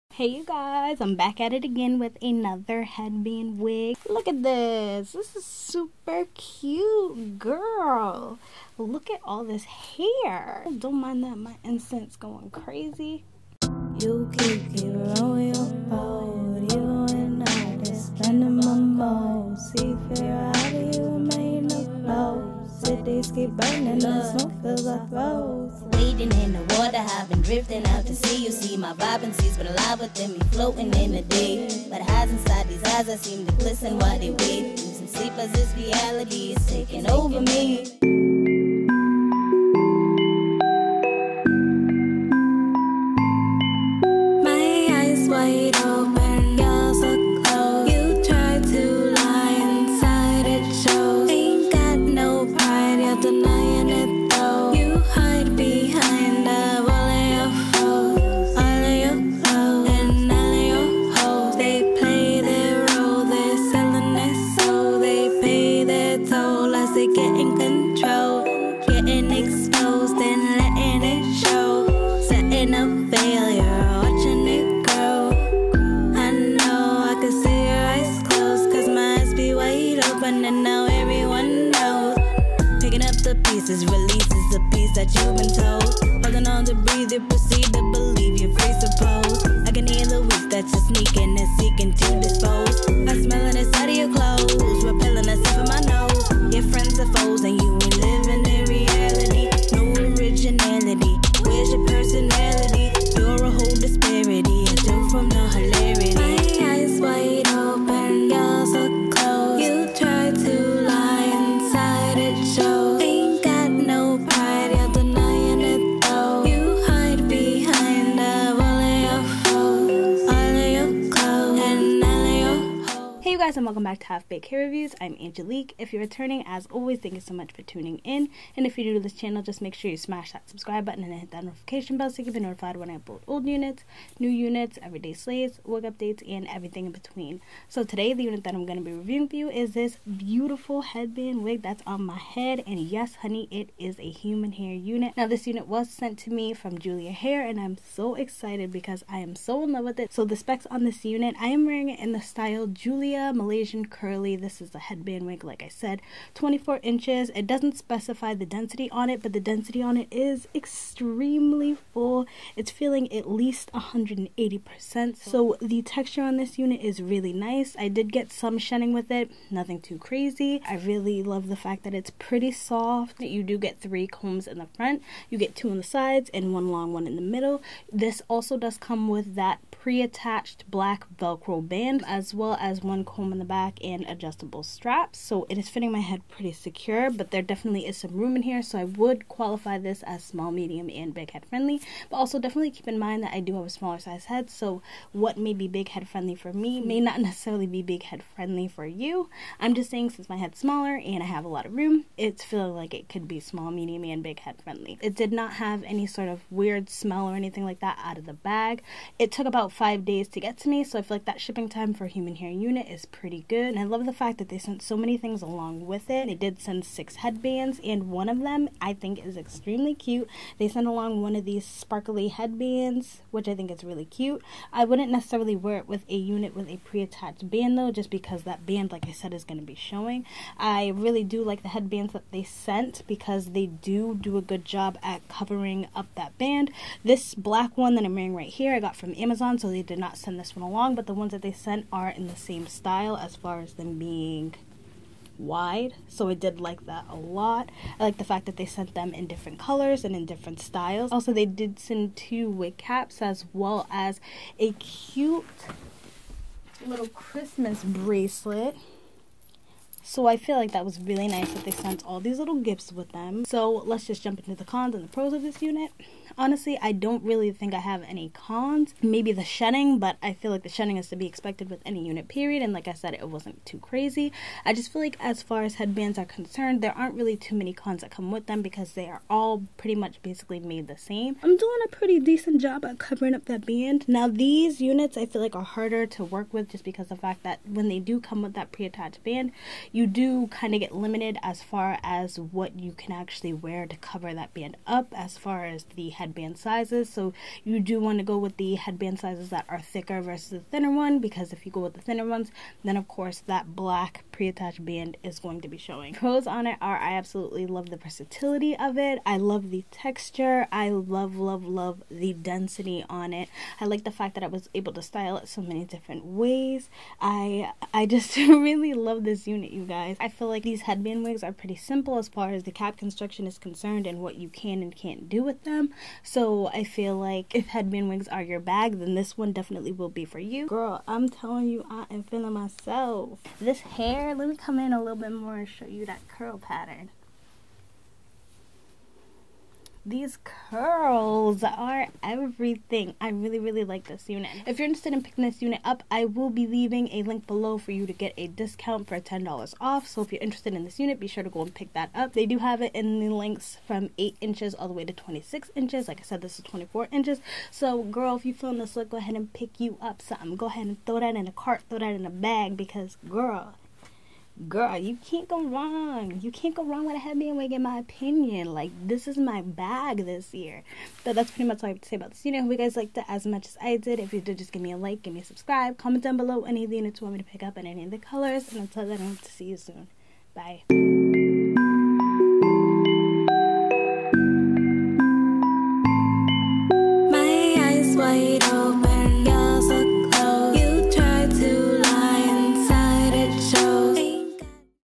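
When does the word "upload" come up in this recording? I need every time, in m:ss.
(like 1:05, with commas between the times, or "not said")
2:12.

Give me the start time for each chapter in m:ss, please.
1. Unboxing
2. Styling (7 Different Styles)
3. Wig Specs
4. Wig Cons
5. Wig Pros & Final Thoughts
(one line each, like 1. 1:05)
1. 0:38
2. 1:00
3. 2:25
4. 4:24
5. 5:05.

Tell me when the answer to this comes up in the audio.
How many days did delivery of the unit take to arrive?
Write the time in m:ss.
3:29.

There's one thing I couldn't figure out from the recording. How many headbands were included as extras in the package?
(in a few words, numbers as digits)
6.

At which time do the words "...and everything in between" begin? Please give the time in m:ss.
2:16.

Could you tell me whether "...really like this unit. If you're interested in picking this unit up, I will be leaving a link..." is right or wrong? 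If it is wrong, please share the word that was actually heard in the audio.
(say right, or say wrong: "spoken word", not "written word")
right.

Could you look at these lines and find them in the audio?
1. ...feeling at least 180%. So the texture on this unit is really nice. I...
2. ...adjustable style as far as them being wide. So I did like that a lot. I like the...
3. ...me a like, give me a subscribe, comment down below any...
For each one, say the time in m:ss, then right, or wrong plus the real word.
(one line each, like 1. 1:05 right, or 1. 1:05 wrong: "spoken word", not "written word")
1. 2:42 right
2. 4:02 wrong: "style", not "adjustable"
3. 6:14 right.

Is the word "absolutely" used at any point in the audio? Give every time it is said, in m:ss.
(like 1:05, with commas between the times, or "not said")
5:07.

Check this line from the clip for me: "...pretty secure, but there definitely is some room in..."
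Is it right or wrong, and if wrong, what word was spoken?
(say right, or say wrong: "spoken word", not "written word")
right.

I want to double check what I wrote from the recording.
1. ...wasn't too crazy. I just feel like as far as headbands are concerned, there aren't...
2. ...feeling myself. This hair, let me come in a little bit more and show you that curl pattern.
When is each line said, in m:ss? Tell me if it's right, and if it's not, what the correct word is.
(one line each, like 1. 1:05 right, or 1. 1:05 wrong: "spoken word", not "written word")
1. 4:33 right
2. 5:32 right.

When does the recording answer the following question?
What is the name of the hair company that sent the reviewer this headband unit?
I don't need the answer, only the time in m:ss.
2:26.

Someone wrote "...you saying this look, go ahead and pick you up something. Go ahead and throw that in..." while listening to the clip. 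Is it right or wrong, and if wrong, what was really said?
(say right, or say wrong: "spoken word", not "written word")
wrong: "feeling", not "saying".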